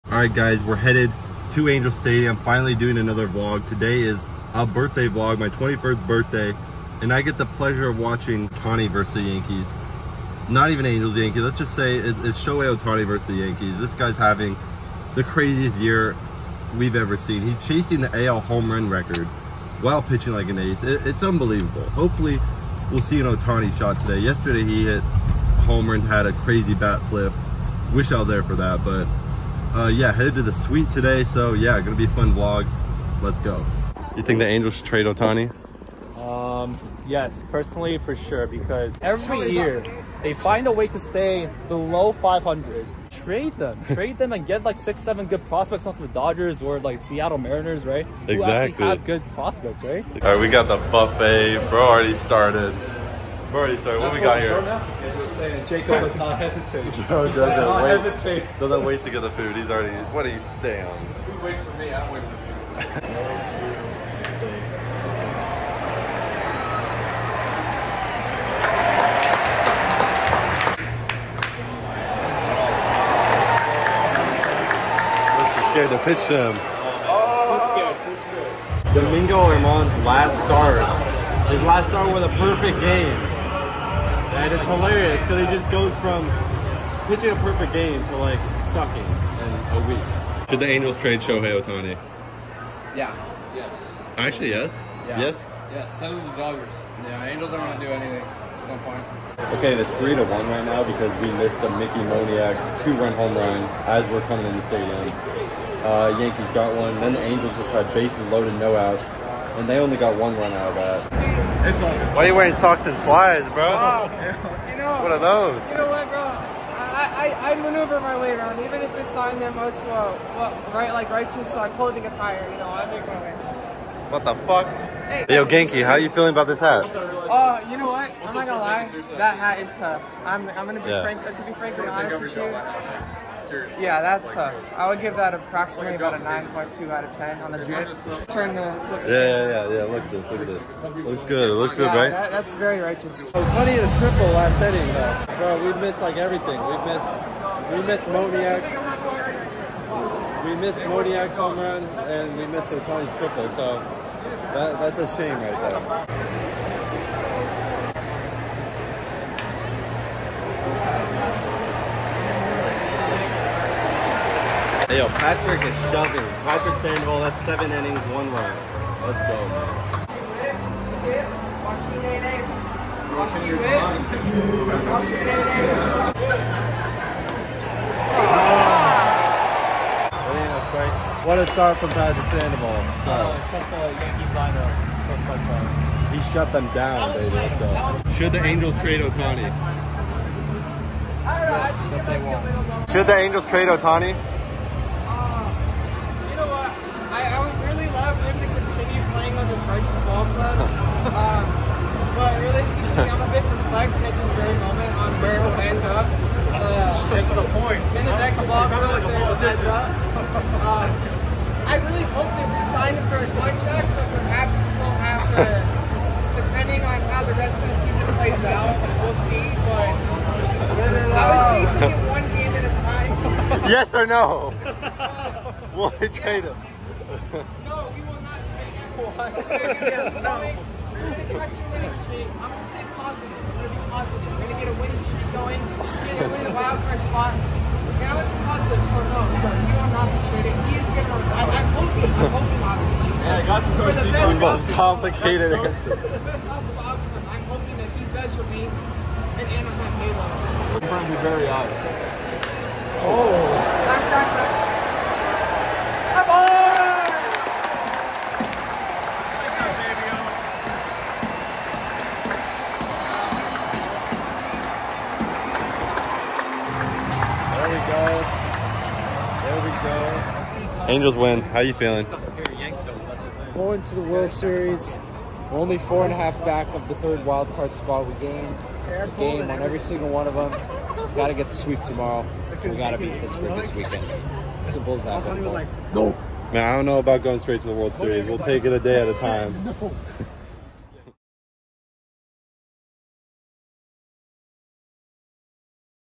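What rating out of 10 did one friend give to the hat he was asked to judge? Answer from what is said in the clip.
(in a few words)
9.2.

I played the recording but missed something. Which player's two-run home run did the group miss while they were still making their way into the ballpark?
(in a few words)
Mickey Moniak.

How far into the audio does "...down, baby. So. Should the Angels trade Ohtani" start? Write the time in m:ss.
3:06.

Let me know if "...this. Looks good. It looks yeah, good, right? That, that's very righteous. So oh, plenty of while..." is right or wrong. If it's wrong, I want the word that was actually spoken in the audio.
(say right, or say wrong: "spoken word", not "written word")
wrong: "triple", not "while".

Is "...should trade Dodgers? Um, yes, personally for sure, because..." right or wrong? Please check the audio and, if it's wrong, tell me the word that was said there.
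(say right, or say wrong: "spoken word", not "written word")
wrong: "Ohtani", not "Dodgers".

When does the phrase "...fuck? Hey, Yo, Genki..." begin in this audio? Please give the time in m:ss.
2:04.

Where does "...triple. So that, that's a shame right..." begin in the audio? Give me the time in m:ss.
2:33.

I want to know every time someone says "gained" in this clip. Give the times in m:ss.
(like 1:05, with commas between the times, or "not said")
4:38.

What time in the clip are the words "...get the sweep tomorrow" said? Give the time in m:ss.
4:41.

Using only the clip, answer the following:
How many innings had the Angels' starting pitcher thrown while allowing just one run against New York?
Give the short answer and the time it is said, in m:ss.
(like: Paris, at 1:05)
7, at 2:47.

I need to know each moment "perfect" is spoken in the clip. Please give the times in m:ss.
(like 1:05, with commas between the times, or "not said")
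1:22, 1:27.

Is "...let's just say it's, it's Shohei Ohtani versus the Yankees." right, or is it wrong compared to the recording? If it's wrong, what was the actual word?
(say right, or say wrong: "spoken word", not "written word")
right.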